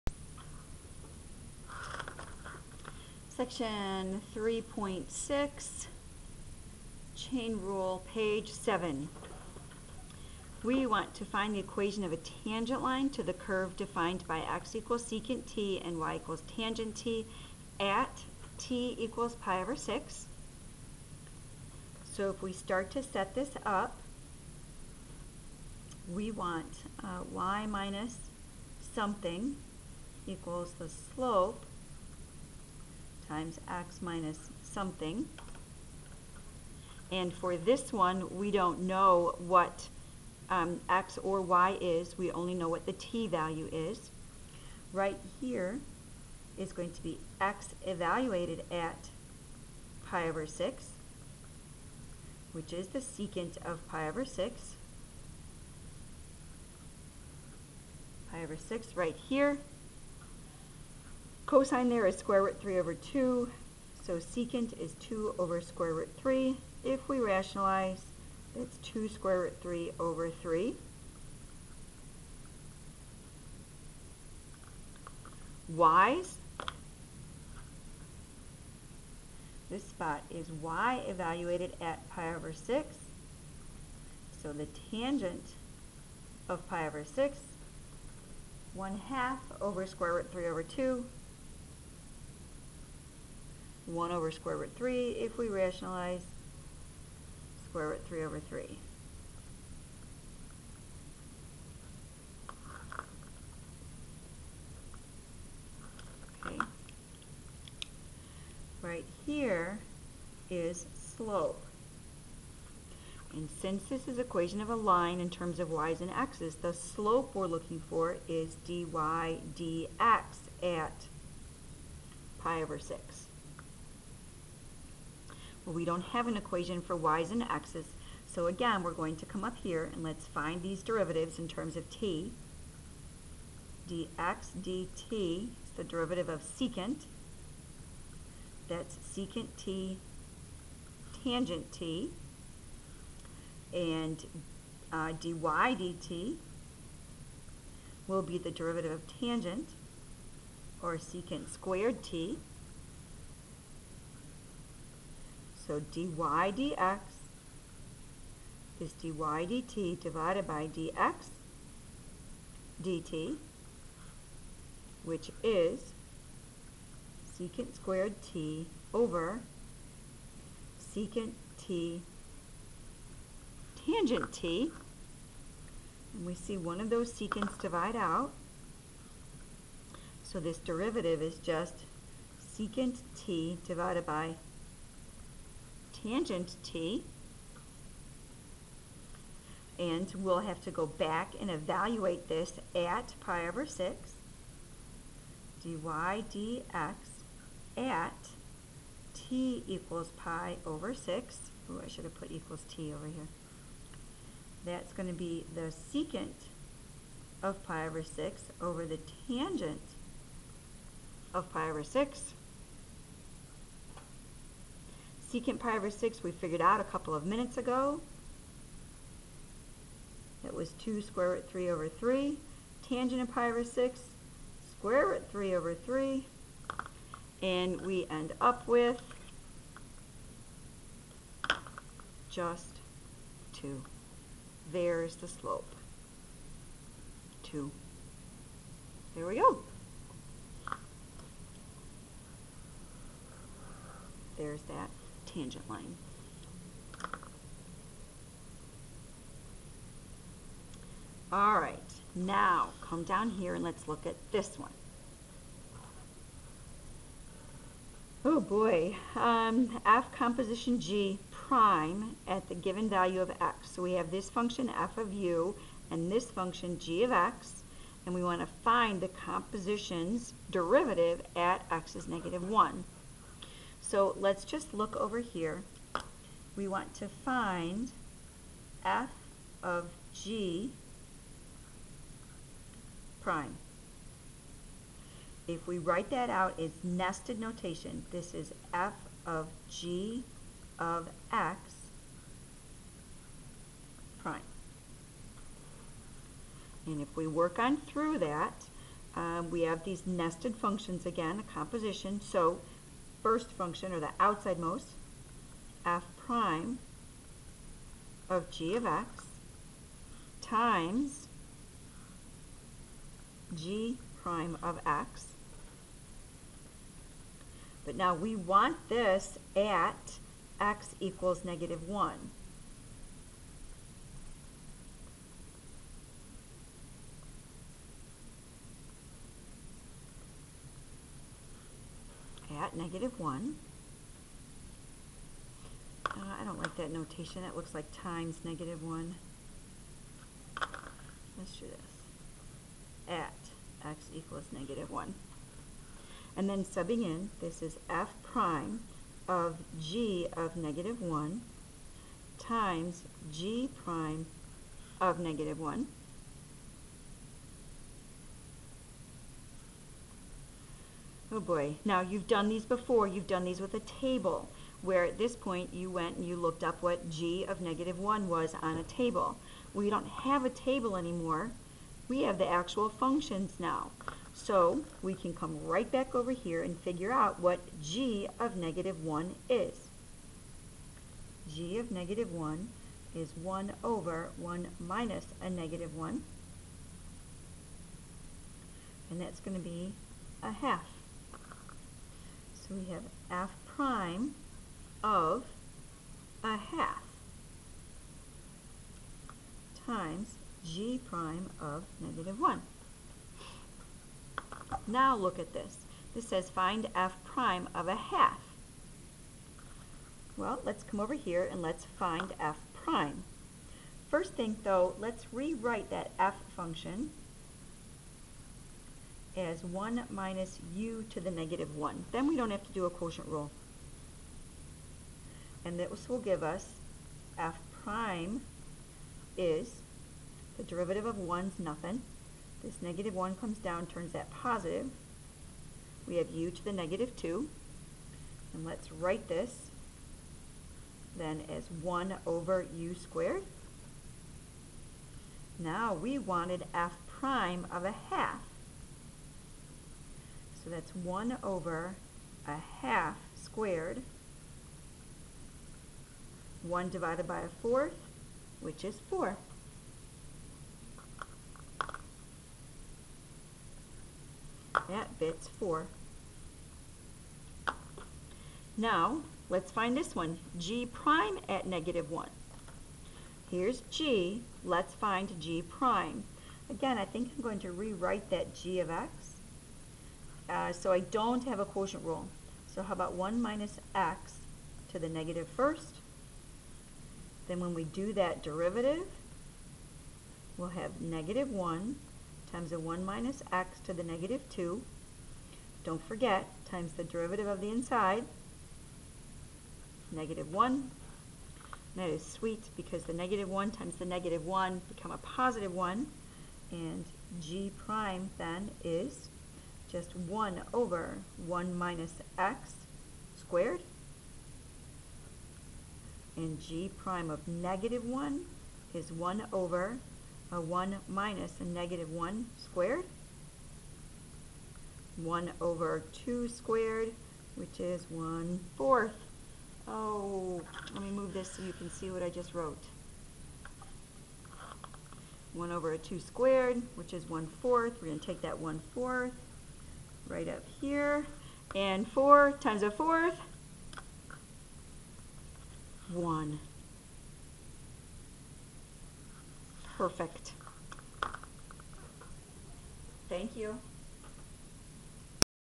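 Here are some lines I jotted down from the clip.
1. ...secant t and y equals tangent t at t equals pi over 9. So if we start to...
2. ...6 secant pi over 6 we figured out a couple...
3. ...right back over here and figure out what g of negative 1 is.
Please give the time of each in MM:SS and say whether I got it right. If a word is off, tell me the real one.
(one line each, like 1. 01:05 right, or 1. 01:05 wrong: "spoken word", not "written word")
1. 00:15 wrong: "6", not "9"
2. 03:31 right
3. 06:15 right.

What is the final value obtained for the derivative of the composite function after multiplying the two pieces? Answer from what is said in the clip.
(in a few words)
1.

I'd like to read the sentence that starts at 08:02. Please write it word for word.
So how about 1 minus x to the negative first?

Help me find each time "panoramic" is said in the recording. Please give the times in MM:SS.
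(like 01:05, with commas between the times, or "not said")
not said.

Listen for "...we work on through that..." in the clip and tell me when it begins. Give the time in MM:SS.
04:57.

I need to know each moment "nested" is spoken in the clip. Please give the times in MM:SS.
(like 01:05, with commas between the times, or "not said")
04:46, 05:00.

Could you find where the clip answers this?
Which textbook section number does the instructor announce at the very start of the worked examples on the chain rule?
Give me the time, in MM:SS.
00:03.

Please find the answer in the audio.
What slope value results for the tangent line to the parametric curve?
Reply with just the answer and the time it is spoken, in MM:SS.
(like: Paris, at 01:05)
2, at 03:47.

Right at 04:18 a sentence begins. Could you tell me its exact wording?
Oh boy, um, f composition g prime at the given value of x.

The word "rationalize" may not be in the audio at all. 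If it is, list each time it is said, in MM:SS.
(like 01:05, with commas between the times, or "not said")
01:07, 01:35.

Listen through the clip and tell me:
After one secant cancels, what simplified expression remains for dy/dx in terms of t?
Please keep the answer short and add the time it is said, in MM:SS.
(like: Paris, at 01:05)
secant t divided by tangent t, at 03:02.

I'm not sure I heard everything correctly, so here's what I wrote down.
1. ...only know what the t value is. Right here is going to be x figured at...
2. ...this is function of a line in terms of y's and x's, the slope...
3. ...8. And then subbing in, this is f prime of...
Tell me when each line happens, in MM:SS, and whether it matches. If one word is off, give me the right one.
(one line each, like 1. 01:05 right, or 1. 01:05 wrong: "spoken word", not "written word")
1. 00:42 wrong: "evaluated", not "figured"
2. 01:53 wrong: "equation", not "function"
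3. 05:44 wrong: "1", not "8".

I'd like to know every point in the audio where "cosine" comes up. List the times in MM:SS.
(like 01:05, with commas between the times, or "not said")
01:01.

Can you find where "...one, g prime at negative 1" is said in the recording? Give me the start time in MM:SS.
07:50.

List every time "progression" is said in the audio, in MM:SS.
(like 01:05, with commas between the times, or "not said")
not said.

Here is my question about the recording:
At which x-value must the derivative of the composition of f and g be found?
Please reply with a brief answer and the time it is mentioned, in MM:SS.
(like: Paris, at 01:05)
negative 1, at 04:31.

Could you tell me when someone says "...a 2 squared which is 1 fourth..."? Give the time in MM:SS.
08:55.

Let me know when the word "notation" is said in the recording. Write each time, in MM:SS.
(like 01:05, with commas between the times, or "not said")
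04:47, 05:36.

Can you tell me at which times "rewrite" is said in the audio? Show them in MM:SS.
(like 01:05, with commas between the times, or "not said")
06:55, 07:57.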